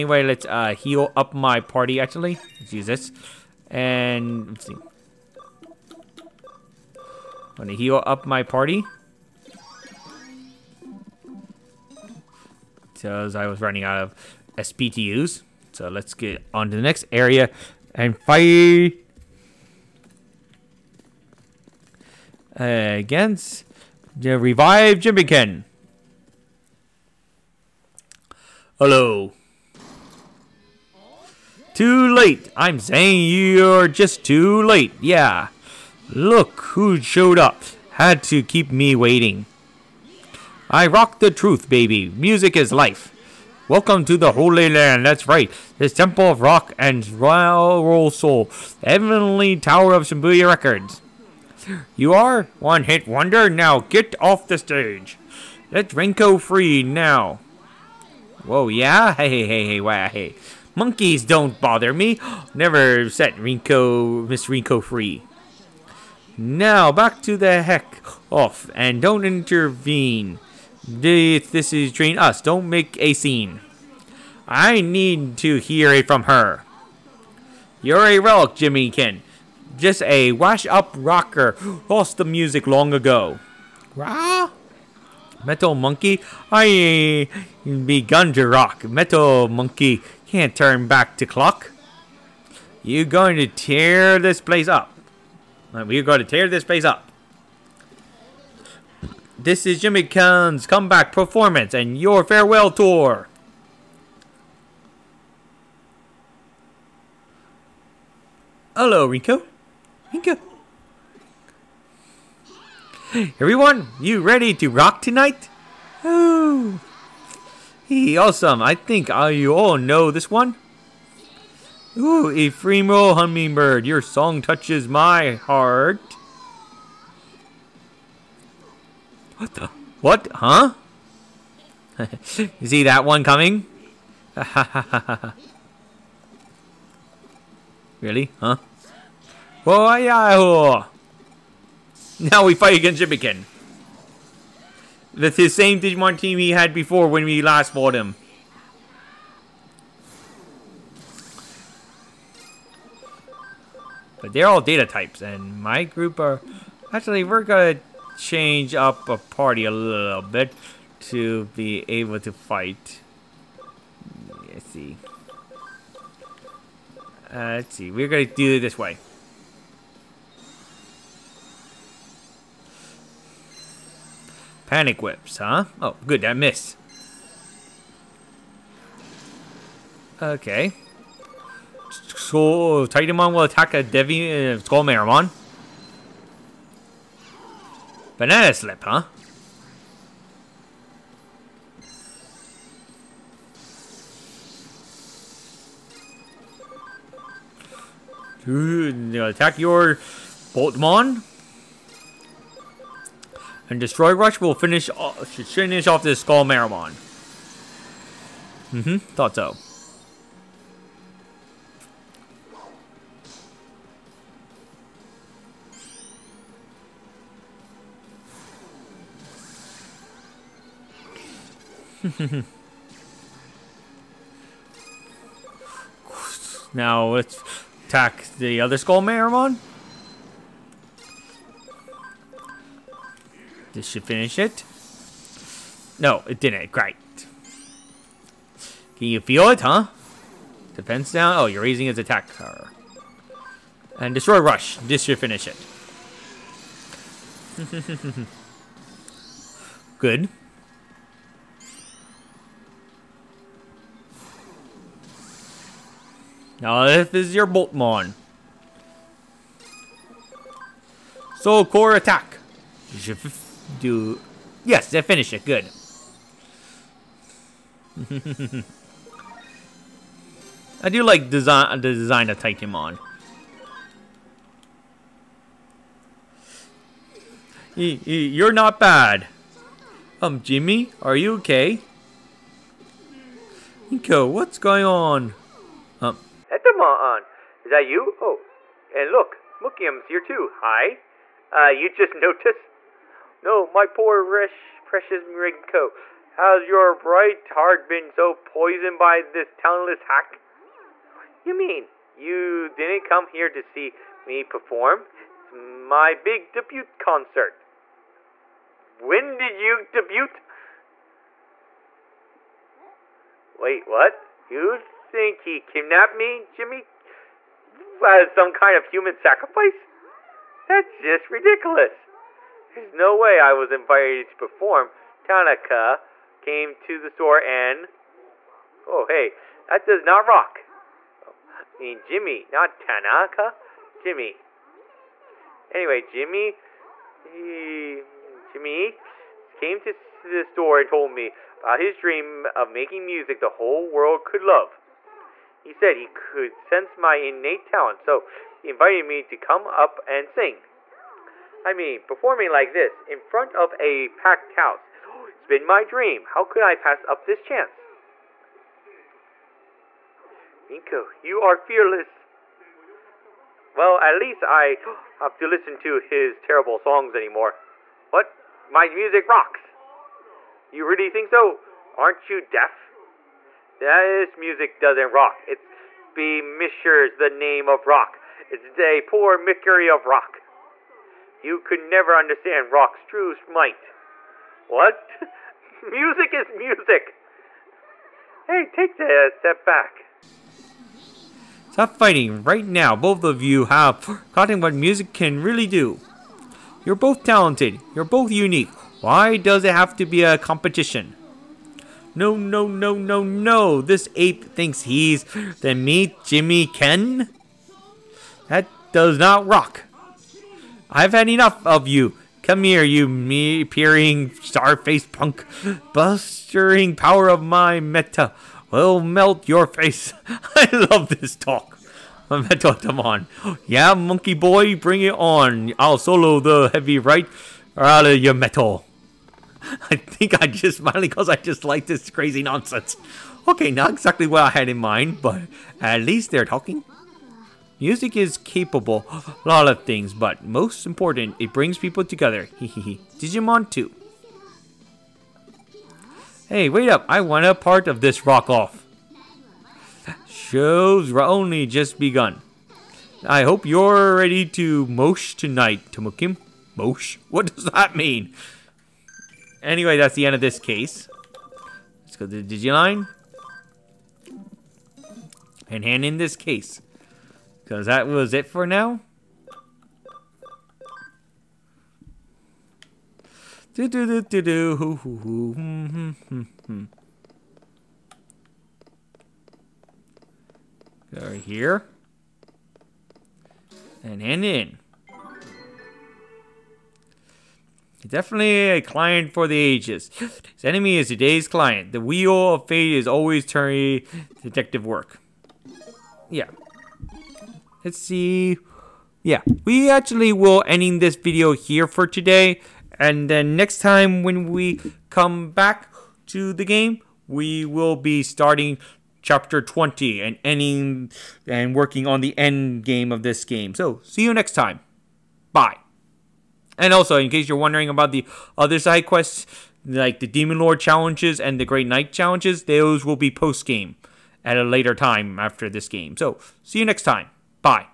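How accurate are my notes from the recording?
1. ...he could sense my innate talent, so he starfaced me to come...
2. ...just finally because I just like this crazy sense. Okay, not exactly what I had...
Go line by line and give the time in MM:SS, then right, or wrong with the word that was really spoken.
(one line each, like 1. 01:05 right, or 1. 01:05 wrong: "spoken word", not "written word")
1. 05:45 wrong: "invited", not "starfaced"
2. 07:10 wrong: "nonsense", not "sense".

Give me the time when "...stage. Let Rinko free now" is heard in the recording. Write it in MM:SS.
00:54.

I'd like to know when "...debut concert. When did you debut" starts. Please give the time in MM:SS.
05:06.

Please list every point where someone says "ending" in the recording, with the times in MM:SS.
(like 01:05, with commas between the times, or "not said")
08:20, 08:30.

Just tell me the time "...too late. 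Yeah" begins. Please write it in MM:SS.
00:34.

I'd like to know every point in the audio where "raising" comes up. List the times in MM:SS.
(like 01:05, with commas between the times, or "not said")
04:01.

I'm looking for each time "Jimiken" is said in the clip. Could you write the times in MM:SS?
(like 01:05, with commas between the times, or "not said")
00:25, 01:18, 01:39, 02:23, 06:46.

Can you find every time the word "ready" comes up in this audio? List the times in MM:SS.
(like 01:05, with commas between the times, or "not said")
01:54, 07:34.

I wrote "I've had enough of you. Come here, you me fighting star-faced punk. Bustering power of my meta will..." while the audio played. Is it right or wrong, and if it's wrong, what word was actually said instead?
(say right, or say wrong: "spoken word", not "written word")
wrong: "peering", not "fighting".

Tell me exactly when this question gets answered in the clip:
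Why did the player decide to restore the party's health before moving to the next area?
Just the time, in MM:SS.
00:13.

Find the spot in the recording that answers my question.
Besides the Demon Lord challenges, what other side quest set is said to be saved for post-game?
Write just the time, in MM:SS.
08:41.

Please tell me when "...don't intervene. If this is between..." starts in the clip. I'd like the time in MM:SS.
01:09.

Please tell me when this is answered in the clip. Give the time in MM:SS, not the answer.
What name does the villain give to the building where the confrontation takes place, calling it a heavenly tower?
00:50.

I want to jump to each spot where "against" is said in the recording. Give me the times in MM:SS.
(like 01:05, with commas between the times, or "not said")
00:22, 02:22.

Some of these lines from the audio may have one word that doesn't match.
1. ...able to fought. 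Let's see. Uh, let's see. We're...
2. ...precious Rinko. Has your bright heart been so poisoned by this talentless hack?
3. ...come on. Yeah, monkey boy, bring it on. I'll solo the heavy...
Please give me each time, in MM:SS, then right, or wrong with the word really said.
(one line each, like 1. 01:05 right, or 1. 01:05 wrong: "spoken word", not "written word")
1. 02:41 wrong: "fight", not "fought"
2. 04:54 right
3. 07:02 right.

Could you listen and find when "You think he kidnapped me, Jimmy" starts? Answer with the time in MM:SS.
05:14.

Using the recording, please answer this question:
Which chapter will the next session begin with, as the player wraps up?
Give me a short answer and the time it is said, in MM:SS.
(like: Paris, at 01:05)
Chapter 20, at 08:29.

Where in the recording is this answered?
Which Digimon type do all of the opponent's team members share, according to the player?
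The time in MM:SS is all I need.
02:34.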